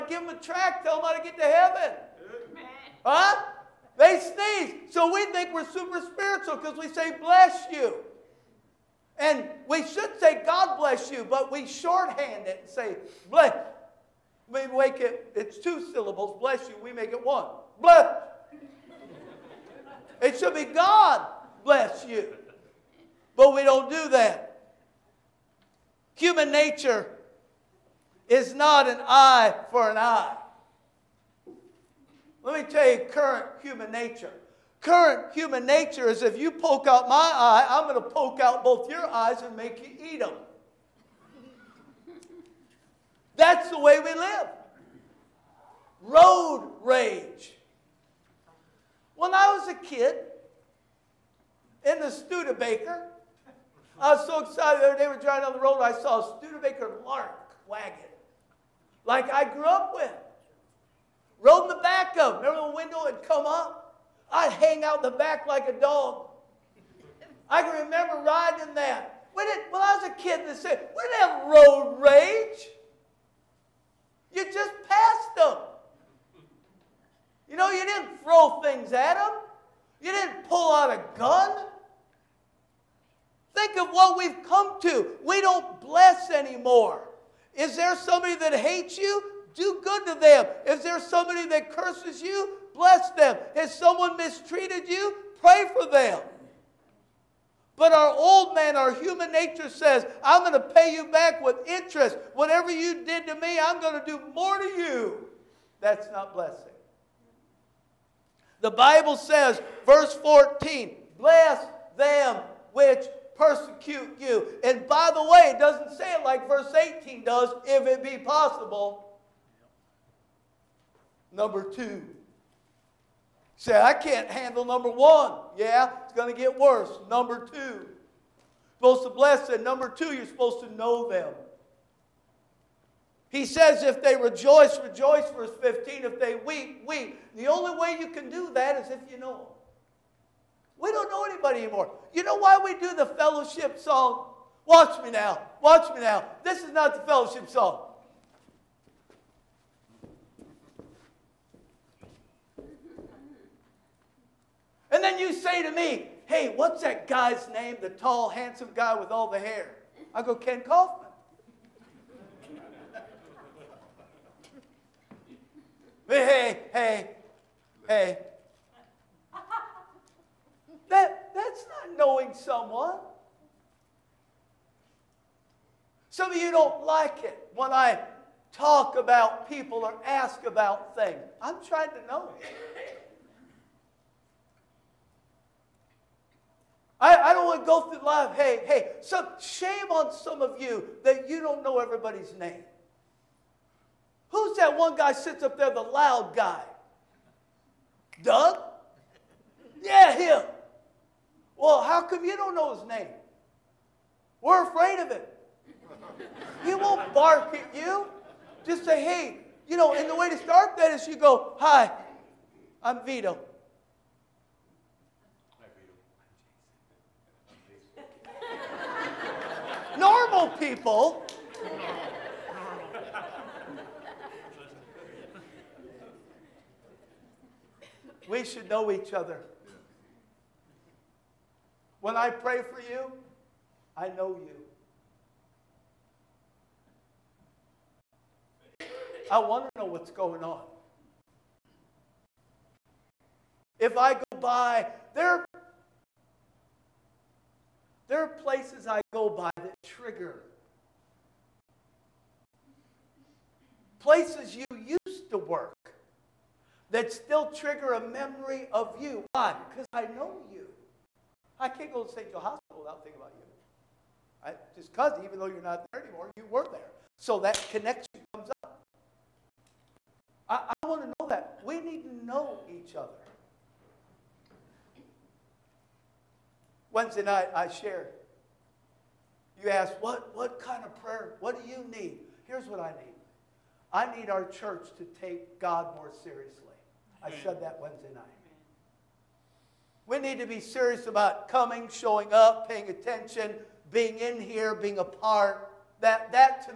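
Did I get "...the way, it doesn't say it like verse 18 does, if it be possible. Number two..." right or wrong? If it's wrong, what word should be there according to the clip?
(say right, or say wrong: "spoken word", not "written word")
right.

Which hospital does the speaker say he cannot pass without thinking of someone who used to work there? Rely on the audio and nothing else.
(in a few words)
St. Joe Hospital.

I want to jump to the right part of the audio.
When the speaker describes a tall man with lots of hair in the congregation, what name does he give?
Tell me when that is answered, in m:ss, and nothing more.
2:40.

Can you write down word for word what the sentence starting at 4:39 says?
You ask, what, what kind of prayer?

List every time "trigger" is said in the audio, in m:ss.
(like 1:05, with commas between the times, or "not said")
4:09, 4:17.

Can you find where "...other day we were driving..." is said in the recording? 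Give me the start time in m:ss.
0:54.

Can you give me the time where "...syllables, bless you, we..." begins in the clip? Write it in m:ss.
0:15.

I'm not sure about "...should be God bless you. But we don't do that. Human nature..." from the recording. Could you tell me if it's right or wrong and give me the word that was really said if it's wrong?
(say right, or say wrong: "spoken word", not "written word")
right.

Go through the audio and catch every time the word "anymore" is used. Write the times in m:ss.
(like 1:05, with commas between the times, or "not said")
1:26, 2:21, 4:26.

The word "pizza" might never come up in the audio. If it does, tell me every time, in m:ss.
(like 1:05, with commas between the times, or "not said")
not said.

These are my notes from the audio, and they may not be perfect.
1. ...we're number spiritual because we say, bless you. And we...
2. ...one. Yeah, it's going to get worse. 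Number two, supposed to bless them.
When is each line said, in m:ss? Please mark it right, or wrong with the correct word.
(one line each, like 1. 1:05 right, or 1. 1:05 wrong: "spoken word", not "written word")
1. 0:05 wrong: "super", not "number"
2. 2:04 right.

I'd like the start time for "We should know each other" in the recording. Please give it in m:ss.
3:48.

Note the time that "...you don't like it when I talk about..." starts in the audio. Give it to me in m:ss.
2:56.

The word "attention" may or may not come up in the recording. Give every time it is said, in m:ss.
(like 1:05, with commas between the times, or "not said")
4:52.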